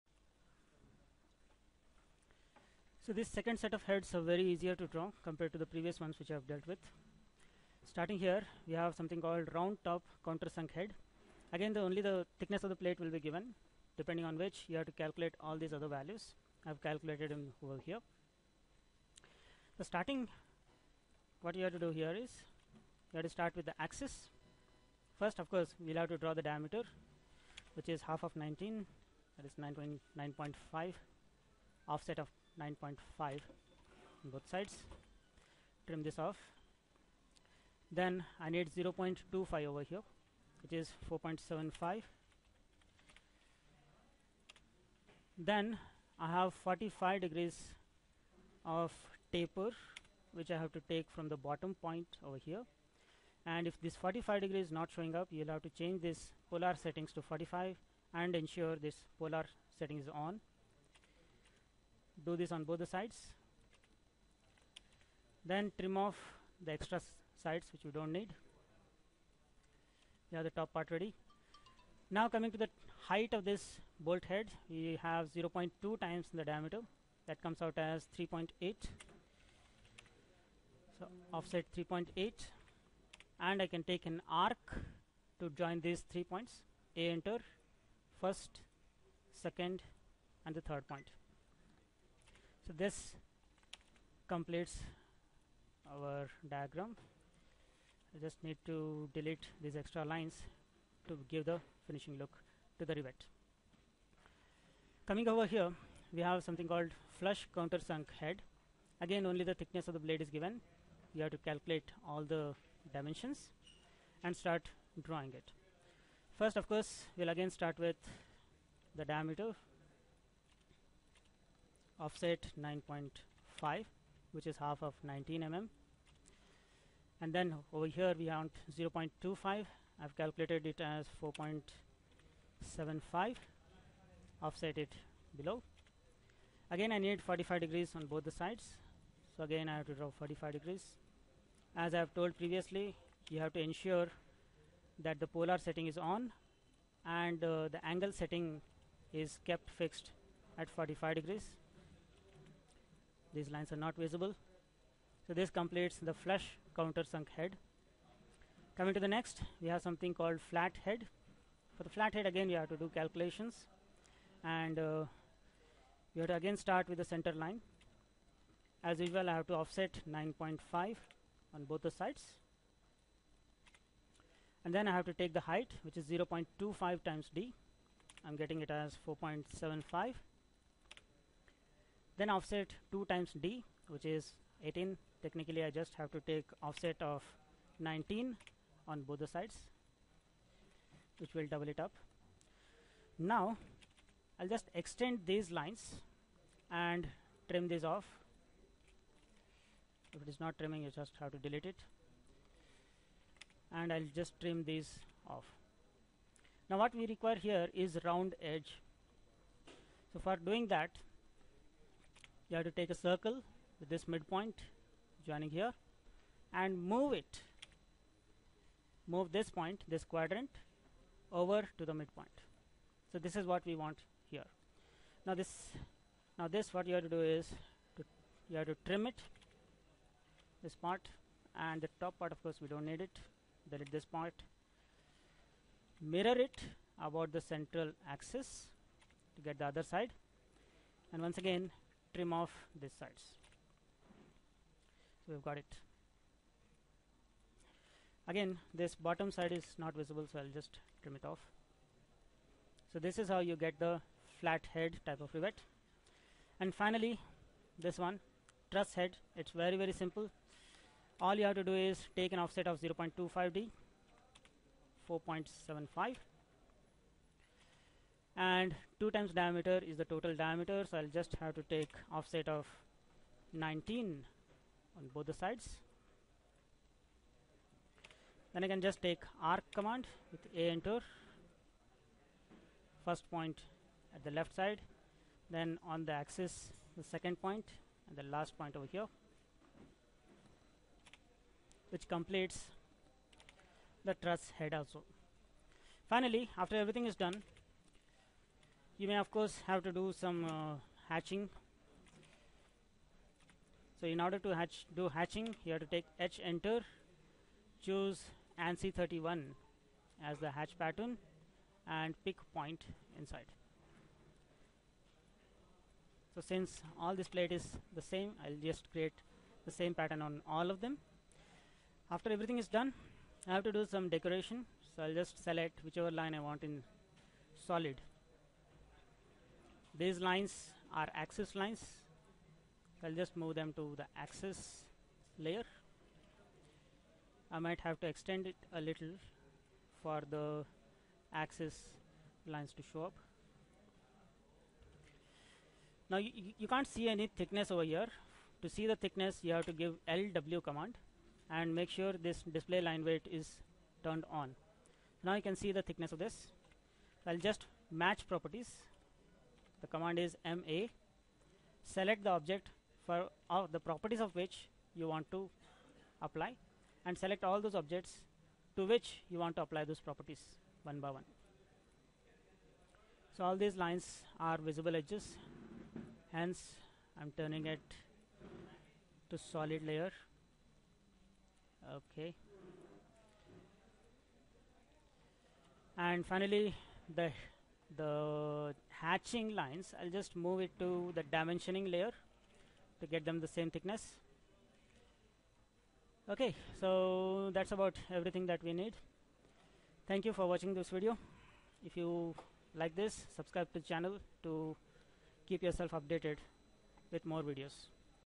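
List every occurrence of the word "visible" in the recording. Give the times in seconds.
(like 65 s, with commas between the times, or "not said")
153 s, 249 s, 374 s.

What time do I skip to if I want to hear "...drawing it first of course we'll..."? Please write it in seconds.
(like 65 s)
115 s.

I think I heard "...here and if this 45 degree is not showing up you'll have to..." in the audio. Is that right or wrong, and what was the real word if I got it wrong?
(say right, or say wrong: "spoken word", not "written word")
right.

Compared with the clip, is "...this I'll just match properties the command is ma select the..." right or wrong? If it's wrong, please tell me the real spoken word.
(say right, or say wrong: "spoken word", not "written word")
right.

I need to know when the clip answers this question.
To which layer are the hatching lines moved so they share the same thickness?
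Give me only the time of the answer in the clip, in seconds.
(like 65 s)
391 s.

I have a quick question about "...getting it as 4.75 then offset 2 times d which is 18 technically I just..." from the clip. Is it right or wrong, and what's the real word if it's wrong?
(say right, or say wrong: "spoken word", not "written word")
right.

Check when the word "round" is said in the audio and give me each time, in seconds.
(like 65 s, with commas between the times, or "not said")
9 s, 208 s.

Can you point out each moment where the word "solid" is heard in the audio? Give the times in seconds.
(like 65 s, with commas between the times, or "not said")
327 s, 379 s.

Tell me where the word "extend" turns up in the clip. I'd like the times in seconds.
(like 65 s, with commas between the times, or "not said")
194 s, 338 s.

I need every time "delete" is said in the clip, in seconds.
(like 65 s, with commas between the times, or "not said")
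99 s, 201 s, 233 s.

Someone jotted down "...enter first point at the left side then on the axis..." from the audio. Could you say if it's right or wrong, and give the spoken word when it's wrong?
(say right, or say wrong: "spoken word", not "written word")
right.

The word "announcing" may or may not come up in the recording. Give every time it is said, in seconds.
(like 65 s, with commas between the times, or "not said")
not said.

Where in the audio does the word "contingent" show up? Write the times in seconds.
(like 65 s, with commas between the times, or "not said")
not said.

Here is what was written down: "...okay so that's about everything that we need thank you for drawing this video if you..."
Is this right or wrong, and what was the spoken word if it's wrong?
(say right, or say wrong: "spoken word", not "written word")
wrong: "watching", not "drawing".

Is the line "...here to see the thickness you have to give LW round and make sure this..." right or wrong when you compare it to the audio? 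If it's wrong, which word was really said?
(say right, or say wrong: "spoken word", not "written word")
wrong: "command", not "round".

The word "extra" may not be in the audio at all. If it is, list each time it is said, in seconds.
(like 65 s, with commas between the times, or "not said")
66 s, 99 s.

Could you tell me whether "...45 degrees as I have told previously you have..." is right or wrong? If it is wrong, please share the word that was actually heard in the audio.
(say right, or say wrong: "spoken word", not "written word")
right.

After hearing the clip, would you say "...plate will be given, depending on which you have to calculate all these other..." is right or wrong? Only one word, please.
right.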